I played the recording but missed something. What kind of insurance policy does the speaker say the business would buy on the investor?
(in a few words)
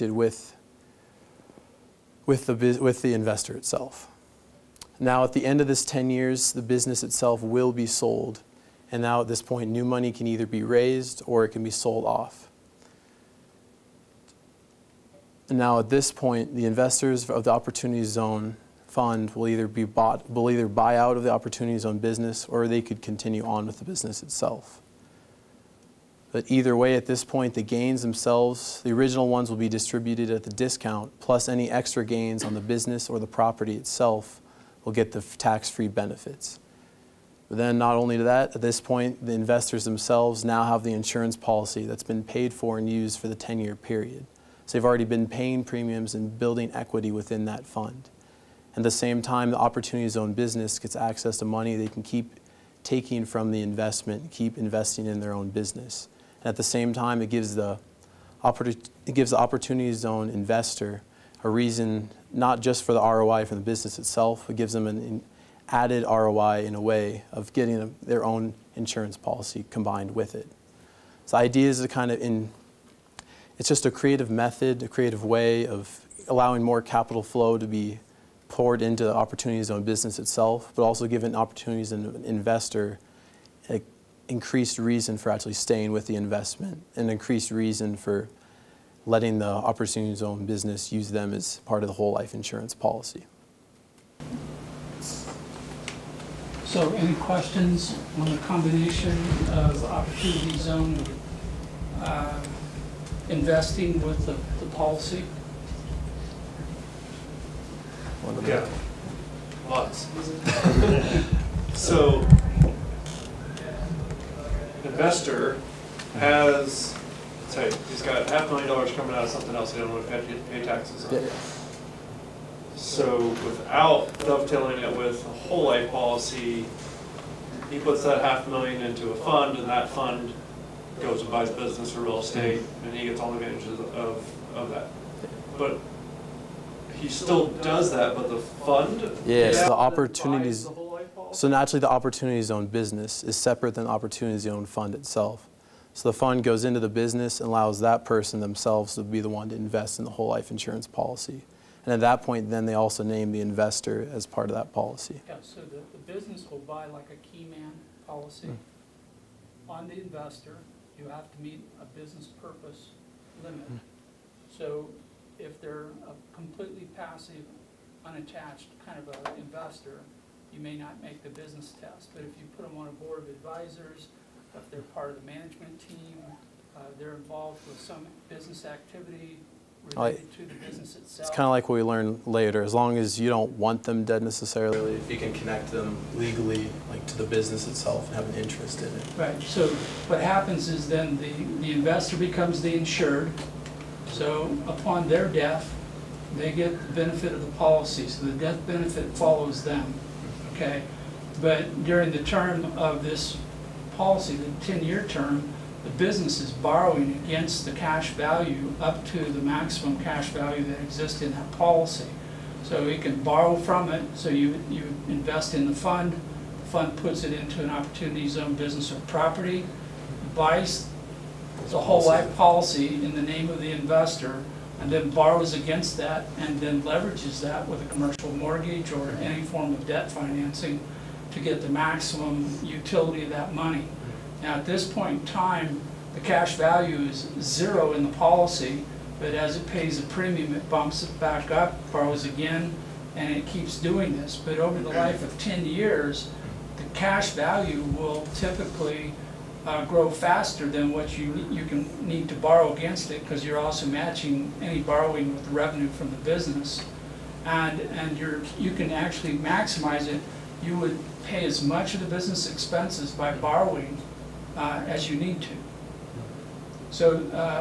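key man policy.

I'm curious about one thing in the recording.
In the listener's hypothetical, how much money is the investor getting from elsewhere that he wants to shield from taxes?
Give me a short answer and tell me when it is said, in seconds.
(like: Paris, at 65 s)
half a million dollars, at 118 s.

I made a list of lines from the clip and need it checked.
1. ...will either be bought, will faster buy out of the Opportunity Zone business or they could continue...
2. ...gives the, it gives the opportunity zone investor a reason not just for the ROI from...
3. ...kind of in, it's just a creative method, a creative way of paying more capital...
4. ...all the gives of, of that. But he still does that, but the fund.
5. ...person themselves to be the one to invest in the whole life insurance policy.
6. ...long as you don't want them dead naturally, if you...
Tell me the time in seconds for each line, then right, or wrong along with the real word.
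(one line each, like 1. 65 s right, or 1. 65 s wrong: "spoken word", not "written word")
1. 19 s wrong: "either", not "faster"
2. 57 s right
3. 71 s wrong: "allowing", not "paying"
4. 133 s wrong: "advantages", not "gives"
5. 148 s right
6. 182 s wrong: "necessarily", not "naturally".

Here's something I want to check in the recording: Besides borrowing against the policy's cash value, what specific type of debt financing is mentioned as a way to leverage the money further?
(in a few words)
commercial mortgage.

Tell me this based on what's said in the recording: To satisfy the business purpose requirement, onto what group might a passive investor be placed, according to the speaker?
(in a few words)
board of advisors.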